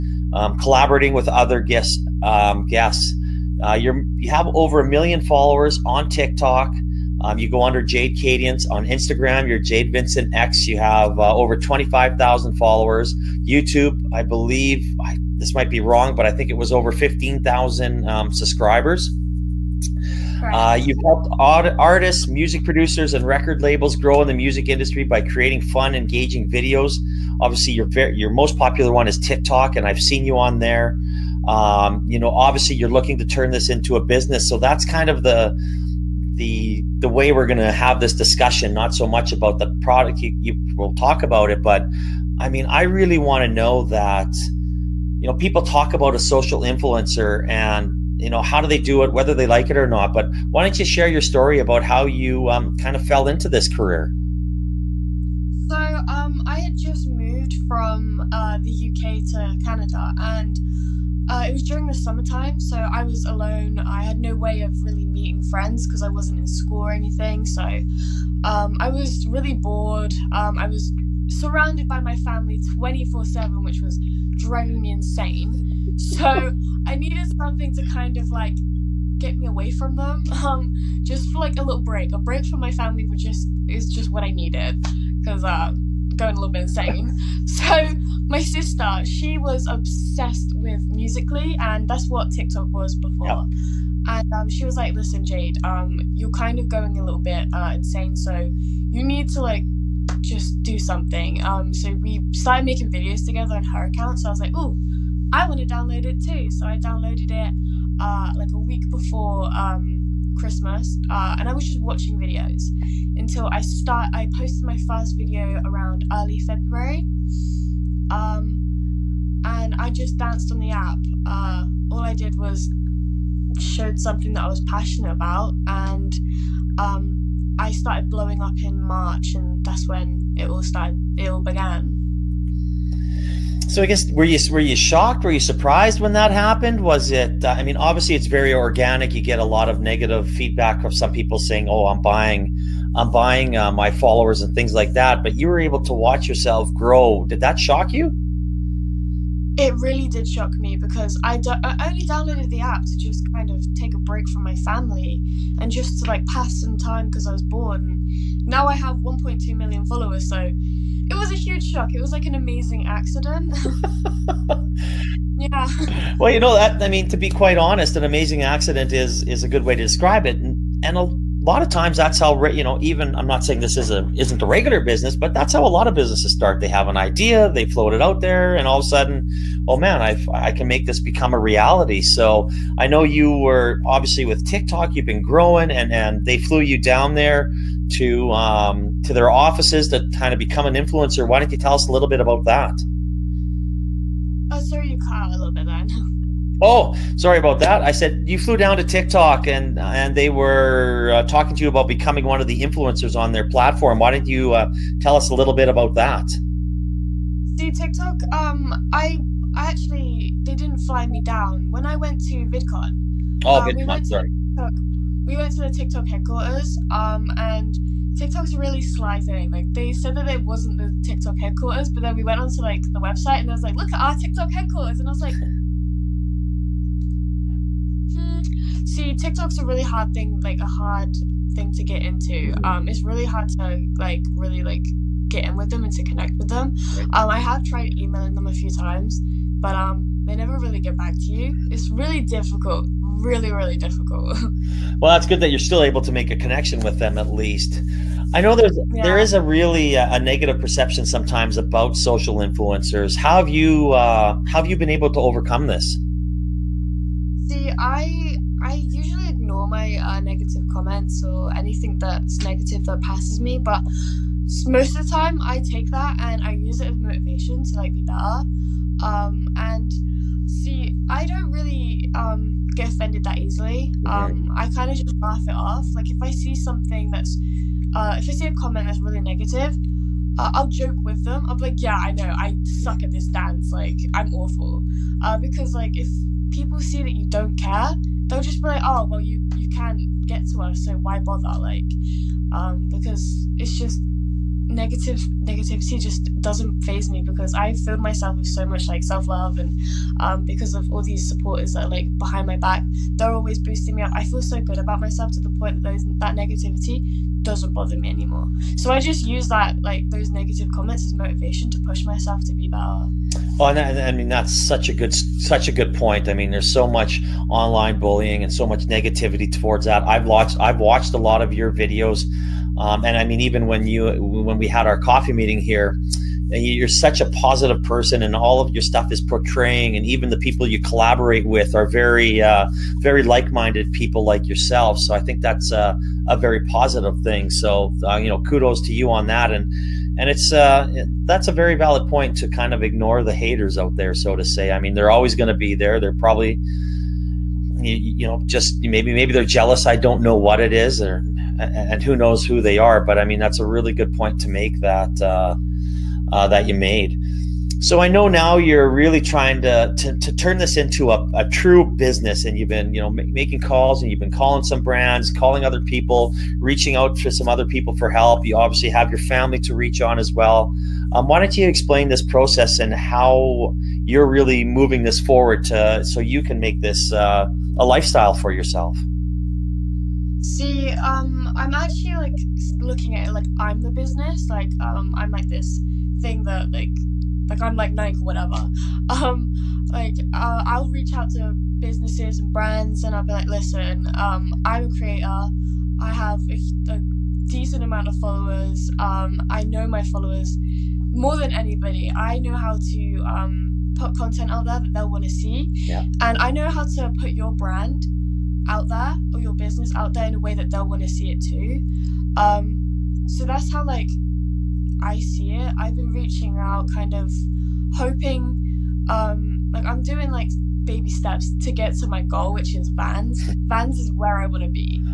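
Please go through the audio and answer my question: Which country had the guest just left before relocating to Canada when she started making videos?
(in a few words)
UK.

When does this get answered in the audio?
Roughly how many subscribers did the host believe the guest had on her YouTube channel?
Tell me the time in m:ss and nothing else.
0:16.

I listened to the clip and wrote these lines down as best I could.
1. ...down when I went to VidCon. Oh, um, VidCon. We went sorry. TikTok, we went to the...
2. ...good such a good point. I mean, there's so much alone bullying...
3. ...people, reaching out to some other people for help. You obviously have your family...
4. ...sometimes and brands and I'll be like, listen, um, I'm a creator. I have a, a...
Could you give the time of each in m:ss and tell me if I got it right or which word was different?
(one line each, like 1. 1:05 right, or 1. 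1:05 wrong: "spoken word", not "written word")
1. 3:31 right
2. 5:14 wrong: "online", not "alone"
3. 6:05 right
4. 6:31 wrong: "businesses", not "sometimes".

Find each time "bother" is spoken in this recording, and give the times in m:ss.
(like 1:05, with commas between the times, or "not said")
4:51, 5:07.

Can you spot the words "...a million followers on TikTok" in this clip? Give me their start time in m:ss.
0:04.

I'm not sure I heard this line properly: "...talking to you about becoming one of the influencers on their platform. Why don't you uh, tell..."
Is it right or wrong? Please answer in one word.
right.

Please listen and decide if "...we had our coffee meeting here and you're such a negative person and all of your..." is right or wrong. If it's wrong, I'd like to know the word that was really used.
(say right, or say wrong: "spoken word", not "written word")
wrong: "positive", not "negative".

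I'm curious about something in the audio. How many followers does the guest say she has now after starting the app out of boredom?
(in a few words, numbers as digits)
1.2 million.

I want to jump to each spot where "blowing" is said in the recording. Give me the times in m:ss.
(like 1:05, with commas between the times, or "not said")
2:08.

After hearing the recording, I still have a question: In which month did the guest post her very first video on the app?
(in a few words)
February.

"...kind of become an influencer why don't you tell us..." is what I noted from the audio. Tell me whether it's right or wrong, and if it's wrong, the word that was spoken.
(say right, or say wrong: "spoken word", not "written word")
right.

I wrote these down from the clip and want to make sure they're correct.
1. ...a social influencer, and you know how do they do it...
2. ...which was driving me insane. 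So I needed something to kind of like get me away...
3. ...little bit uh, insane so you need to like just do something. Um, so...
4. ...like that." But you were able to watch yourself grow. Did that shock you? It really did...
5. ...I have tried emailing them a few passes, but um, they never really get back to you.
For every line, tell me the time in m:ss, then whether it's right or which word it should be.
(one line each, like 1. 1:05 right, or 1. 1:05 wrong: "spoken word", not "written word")
1. 0:46 right
2. 1:13 right
3. 1:37 right
4. 2:24 right
5. 3:57 wrong: "times", not "passes".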